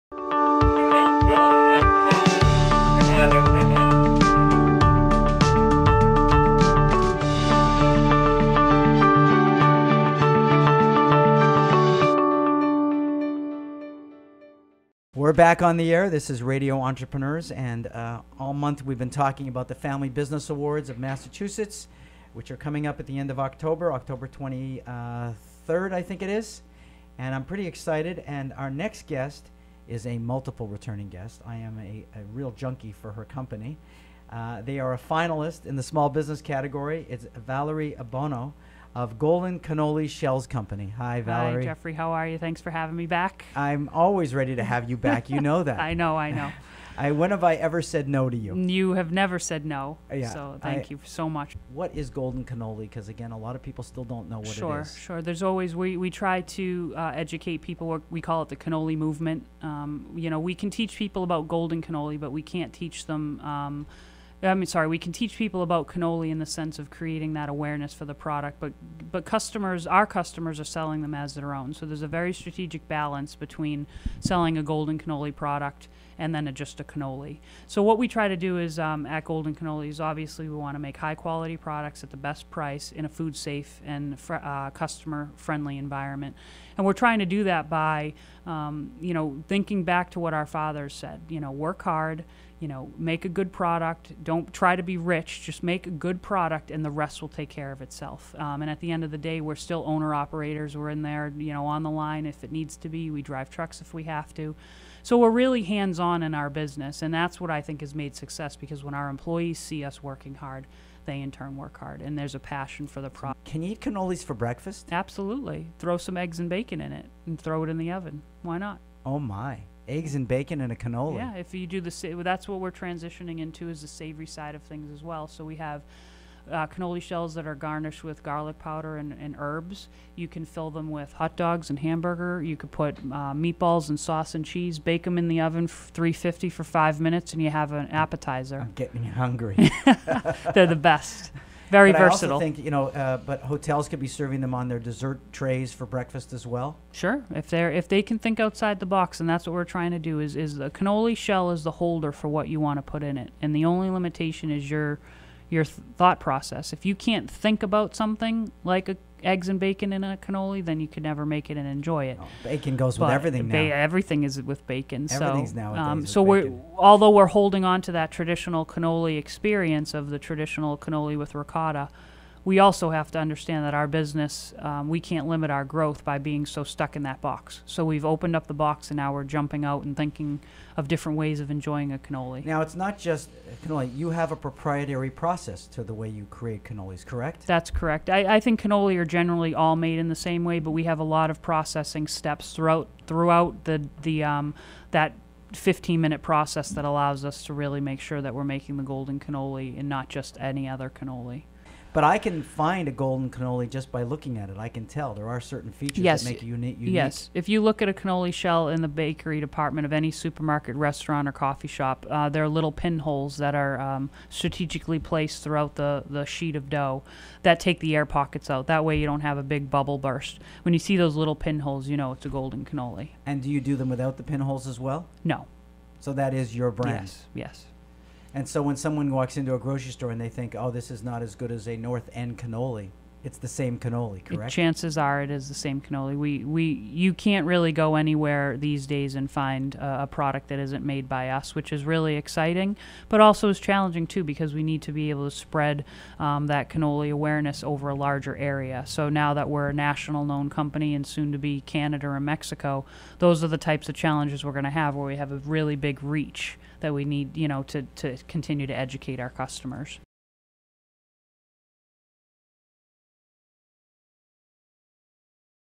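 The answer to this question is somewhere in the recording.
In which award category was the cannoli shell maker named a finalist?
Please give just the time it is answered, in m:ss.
0:35.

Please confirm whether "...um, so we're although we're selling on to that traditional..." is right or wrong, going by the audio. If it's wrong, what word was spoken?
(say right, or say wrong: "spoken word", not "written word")
wrong: "holding", not "selling".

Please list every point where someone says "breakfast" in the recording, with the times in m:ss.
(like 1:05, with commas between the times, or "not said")
1:54, 2:25.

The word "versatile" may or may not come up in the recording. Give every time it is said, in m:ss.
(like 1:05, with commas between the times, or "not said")
2:21.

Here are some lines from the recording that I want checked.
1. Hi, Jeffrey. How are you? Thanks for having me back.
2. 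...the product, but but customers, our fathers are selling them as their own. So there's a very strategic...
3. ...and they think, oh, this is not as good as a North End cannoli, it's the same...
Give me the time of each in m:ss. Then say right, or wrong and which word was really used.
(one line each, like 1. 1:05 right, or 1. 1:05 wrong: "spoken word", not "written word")
1. 0:41 right
2. 1:08 wrong: "customers", not "fathers"
3. 3:50 right.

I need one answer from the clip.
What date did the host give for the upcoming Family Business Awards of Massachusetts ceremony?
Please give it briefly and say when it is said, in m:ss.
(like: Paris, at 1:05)
October 23rd, at 0:23.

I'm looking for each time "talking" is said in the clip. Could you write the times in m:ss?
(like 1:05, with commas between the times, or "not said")
0:19.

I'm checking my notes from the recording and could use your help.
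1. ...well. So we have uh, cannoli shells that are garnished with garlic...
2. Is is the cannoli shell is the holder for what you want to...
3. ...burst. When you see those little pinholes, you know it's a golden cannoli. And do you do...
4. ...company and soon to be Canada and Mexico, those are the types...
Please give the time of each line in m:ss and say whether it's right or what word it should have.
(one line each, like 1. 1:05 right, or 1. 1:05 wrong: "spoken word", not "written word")
1. 2:05 right
2. 2:30 right
3. 3:39 right
4. 4:10 right.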